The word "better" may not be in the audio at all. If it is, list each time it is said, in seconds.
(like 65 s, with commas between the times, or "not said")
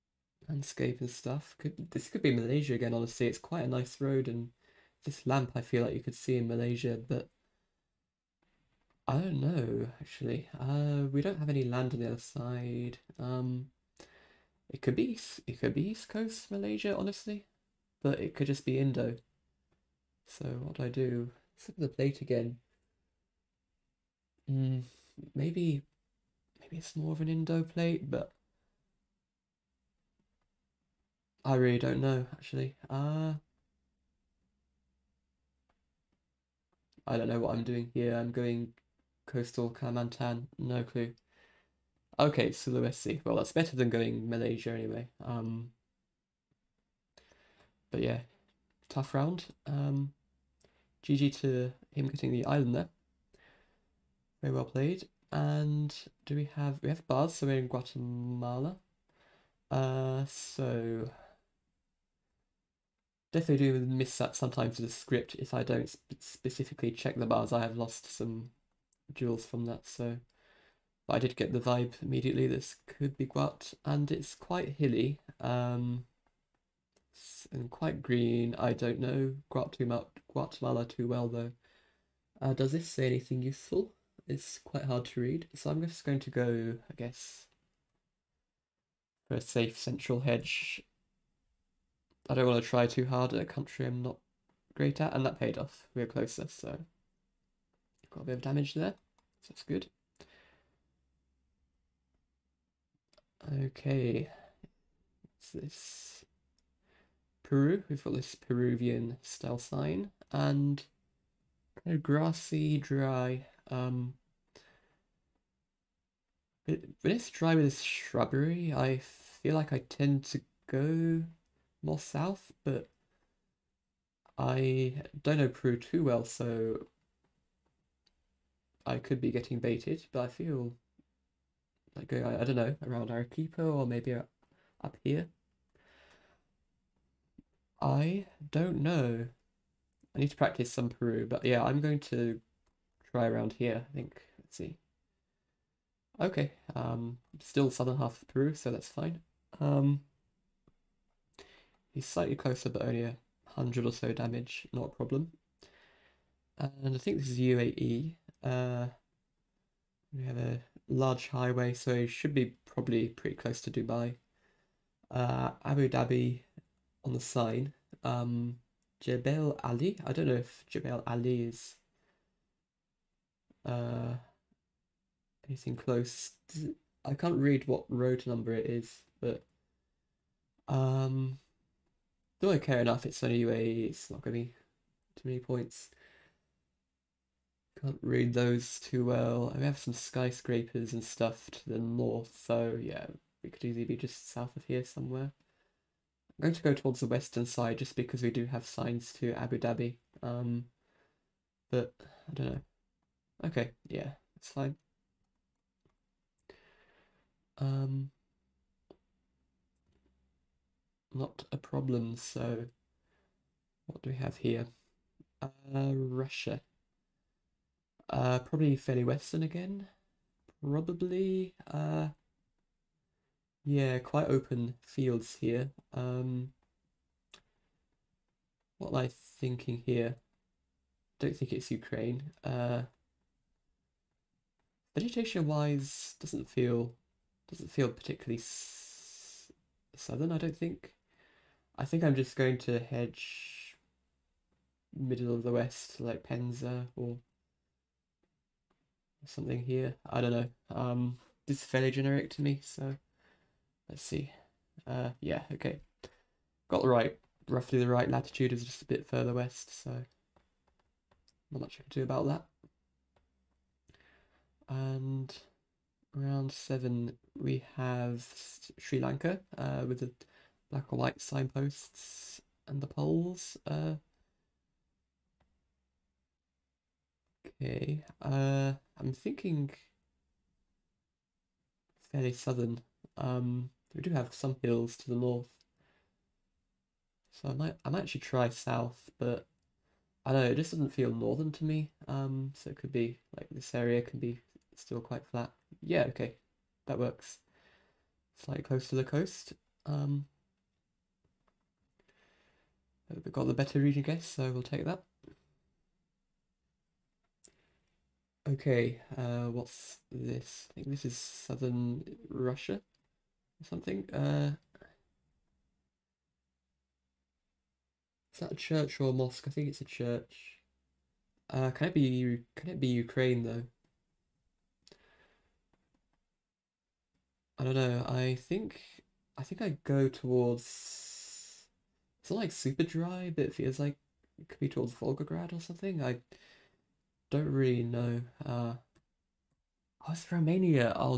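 43 s, 303 s.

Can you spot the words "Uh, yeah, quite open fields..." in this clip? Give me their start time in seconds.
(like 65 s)
221 s.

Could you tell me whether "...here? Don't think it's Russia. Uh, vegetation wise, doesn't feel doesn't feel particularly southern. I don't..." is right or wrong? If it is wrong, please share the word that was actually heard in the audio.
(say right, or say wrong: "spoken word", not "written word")
wrong: "Ukraine", not "Russia".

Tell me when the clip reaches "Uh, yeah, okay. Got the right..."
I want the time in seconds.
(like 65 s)
254 s.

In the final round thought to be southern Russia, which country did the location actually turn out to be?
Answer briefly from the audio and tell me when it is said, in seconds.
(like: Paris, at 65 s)
Romania, at 340 s.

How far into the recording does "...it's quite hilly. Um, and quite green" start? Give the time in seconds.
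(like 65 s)
74 s.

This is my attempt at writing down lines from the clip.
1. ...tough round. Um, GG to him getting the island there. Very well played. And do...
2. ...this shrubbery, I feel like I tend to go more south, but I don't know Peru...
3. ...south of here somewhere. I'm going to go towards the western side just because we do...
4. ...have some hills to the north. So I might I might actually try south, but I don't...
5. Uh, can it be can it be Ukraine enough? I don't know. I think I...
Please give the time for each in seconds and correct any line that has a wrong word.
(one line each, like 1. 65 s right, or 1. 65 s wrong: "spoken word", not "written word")
1. 48 s right
2. 117 s right
3. 194 s right
4. 284 s right
5. 321 s wrong: "though", not "enough".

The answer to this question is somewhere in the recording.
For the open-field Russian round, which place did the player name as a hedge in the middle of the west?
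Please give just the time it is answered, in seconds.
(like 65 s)
246 s.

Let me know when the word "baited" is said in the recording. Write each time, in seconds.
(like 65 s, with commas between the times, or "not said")
129 s.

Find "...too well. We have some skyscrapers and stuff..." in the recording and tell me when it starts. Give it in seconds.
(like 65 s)
188 s.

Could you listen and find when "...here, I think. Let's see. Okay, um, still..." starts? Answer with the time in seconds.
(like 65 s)
143 s.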